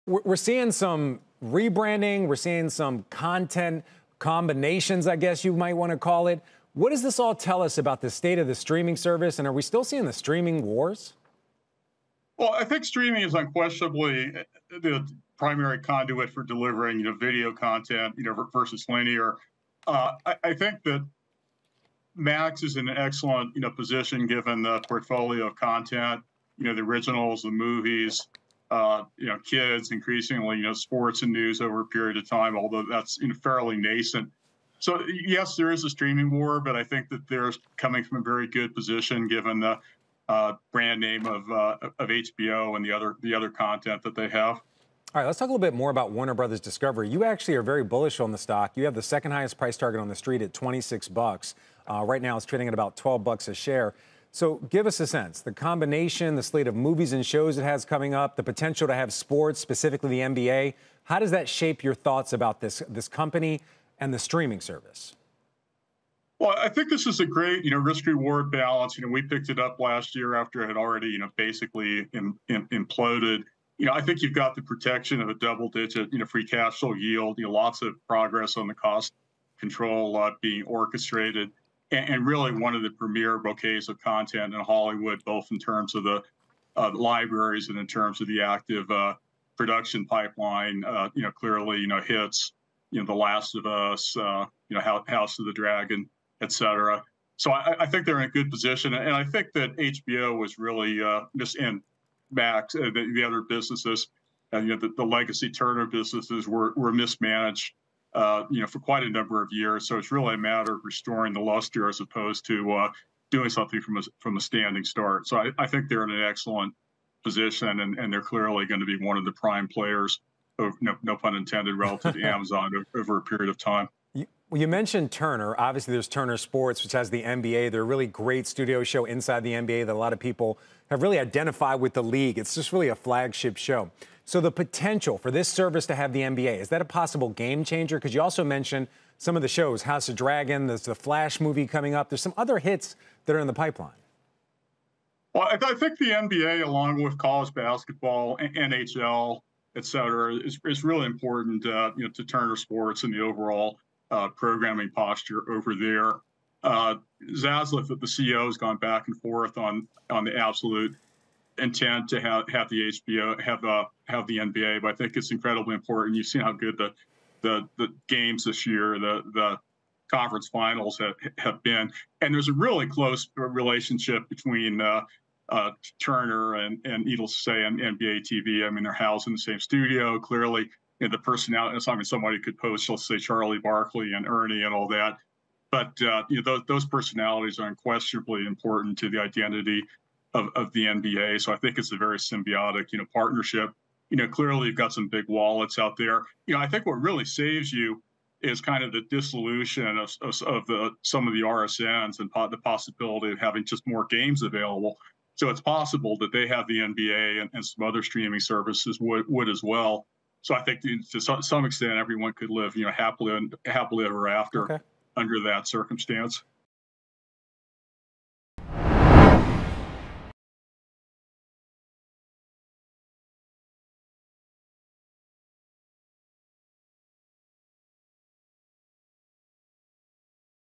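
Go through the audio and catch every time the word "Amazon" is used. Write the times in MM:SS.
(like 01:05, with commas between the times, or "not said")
02:02.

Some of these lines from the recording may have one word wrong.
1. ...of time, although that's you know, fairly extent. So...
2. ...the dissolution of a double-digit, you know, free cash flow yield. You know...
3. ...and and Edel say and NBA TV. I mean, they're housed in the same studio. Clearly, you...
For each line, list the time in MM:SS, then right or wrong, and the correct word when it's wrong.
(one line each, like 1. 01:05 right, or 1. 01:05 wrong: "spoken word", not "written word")
1. 00:32 wrong: "nascent", not "extent"
2. 01:14 wrong: "protection", not "dissolution"
3. 02:56 right.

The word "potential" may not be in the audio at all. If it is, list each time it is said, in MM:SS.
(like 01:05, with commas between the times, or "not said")
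00:58, 02:14.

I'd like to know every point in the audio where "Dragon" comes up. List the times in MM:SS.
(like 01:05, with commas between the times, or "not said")
01:35, 02:20.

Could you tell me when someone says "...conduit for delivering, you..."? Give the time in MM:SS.
00:15.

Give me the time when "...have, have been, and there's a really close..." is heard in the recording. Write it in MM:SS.
02:50.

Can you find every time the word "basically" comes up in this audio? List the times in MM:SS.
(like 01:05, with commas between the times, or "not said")
01:11.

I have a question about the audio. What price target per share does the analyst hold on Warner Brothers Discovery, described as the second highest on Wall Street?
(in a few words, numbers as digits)
$26.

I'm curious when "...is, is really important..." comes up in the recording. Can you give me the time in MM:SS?
02:30.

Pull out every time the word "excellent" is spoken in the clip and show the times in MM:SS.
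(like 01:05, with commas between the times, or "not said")
00:22, 01:56.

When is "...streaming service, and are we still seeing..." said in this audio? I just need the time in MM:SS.
00:08.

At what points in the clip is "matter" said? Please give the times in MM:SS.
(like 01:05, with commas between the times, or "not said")
01:50.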